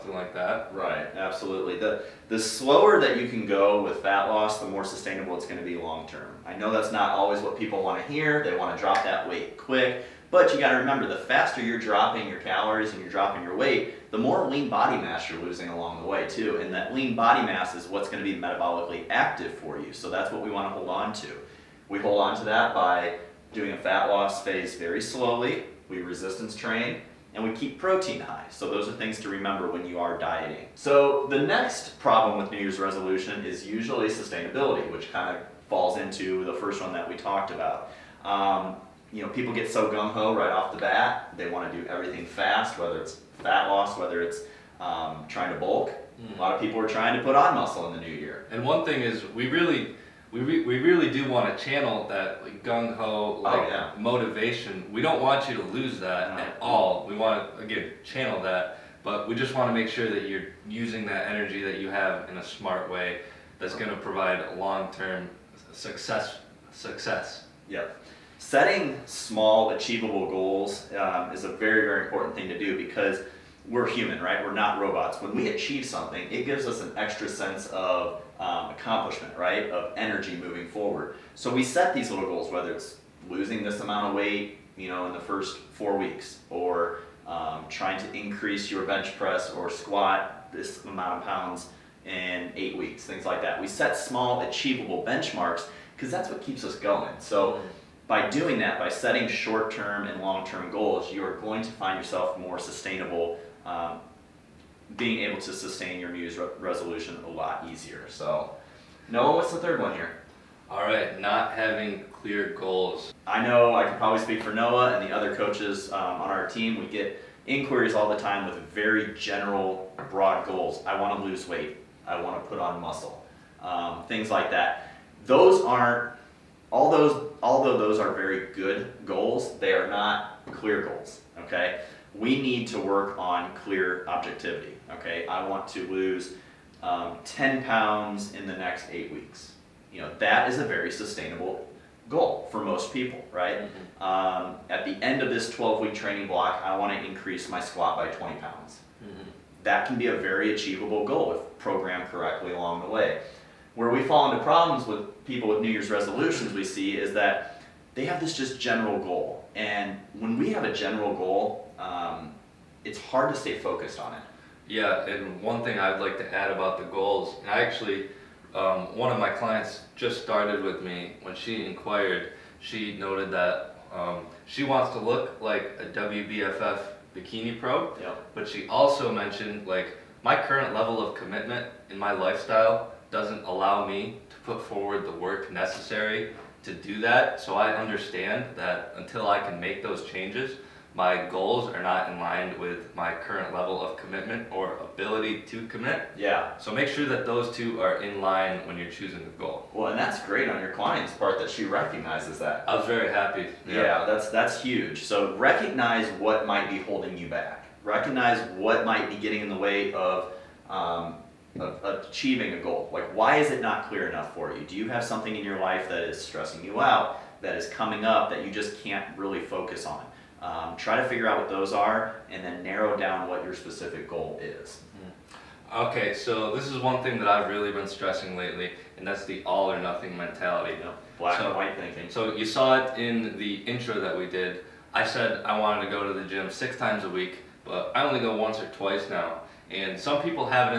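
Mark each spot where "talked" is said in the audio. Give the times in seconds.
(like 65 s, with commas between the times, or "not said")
37 s.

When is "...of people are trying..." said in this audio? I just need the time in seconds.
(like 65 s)
46 s.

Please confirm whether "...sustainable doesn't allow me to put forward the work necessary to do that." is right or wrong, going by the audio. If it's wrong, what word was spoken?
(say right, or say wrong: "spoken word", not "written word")
wrong: "lifestyle", not "sustainable".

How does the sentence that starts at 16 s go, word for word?
And that lean body mass is what's going to be metabolically active for you.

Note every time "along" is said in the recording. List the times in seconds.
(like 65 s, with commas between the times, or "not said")
15 s, 152 s.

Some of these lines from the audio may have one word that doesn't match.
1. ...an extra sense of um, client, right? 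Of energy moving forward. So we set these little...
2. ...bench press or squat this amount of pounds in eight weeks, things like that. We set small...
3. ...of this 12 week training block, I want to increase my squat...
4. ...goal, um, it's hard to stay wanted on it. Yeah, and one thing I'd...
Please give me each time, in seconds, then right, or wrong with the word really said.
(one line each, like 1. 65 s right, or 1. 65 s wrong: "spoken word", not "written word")
1. 76 s wrong: "accomplishment", not "client"
2. 88 s right
3. 145 s right
4. 161 s wrong: "focused", not "wanted".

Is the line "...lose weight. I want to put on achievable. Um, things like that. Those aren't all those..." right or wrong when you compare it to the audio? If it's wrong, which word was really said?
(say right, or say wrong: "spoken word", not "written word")
wrong: "muscle", not "achievable".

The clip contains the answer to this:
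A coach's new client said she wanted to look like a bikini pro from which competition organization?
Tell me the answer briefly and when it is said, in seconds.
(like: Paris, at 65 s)
WBFF, at 175 s.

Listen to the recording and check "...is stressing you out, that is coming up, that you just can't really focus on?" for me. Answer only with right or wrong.
right.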